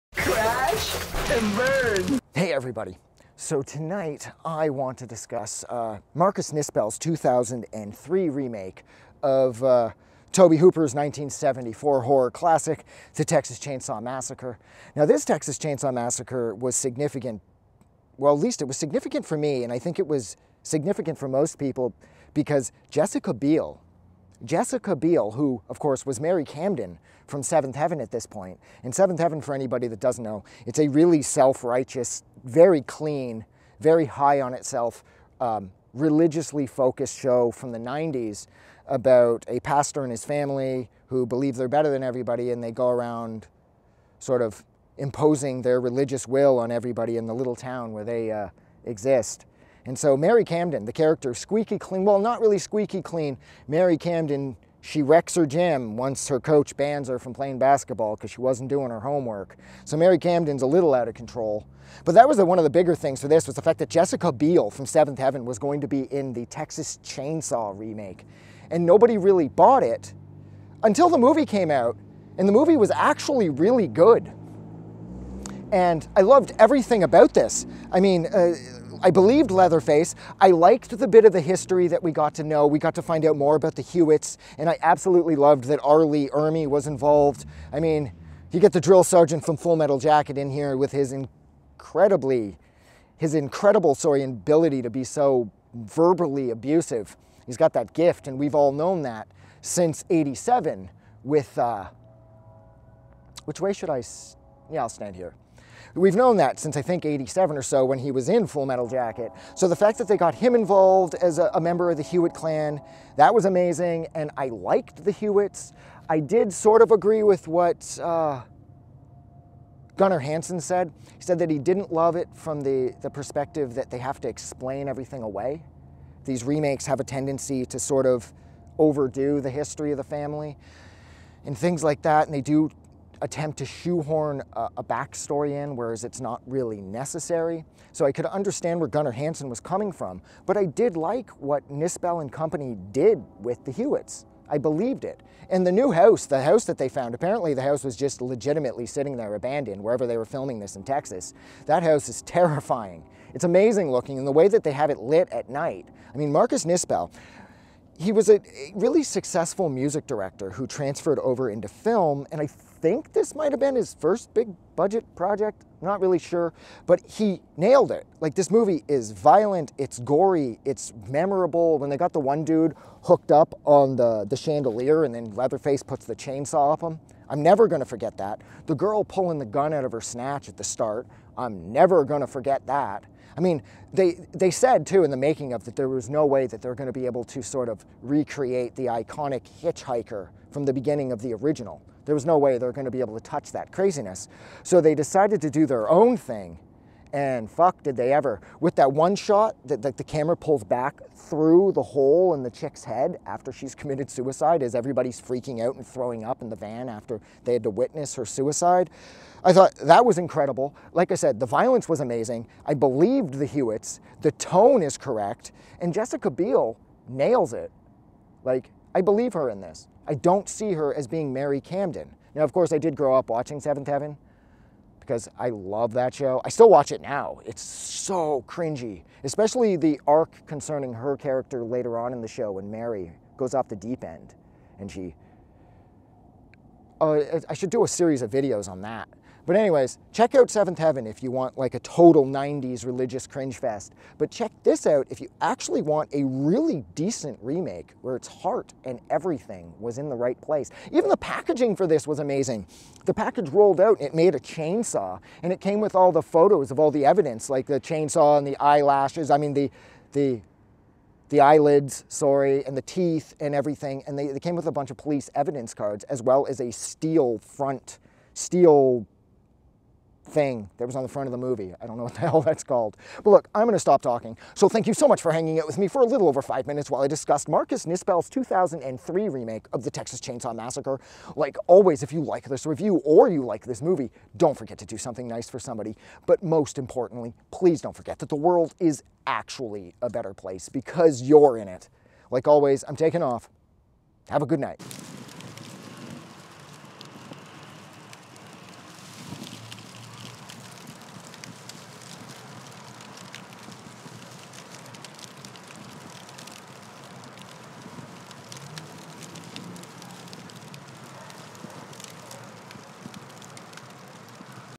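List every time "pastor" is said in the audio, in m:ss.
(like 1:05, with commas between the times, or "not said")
0:39.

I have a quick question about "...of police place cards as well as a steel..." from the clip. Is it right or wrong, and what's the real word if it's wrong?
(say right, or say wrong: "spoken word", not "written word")
wrong: "evidence", not "place".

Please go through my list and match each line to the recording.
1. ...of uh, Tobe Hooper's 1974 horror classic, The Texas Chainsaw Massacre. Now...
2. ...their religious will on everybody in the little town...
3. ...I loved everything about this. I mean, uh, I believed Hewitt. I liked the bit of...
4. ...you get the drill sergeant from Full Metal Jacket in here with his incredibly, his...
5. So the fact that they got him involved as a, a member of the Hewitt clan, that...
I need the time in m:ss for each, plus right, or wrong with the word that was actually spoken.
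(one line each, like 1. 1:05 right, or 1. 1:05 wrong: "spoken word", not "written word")
1. 0:09 right
2. 0:45 right
3. 1:16 wrong: "Leatherface", not "Hewitt"
4. 1:28 right
5. 1:49 right.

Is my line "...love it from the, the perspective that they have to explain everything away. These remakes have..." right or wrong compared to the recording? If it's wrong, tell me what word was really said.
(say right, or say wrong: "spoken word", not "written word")
right.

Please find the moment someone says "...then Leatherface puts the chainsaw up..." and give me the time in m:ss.
2:55.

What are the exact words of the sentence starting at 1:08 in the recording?
And nobody really bought it until the movie came out.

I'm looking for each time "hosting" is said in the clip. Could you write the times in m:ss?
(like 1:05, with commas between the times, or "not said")
not said.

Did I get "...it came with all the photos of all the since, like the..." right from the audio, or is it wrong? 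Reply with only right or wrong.
wrong.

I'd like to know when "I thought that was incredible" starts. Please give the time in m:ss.
3:29.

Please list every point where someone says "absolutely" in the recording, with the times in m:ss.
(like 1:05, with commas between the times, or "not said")
1:24.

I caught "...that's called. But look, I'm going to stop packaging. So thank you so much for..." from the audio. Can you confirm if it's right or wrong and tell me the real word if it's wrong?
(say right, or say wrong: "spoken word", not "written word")
wrong: "talking", not "packaging".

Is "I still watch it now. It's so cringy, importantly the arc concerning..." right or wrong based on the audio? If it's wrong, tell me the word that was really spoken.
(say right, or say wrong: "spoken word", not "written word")
wrong: "especially", not "importantly".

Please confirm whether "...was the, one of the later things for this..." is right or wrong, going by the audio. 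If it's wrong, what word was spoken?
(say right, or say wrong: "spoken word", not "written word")
wrong: "bigger", not "later".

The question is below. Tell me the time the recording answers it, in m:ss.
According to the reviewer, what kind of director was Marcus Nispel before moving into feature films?
2:39.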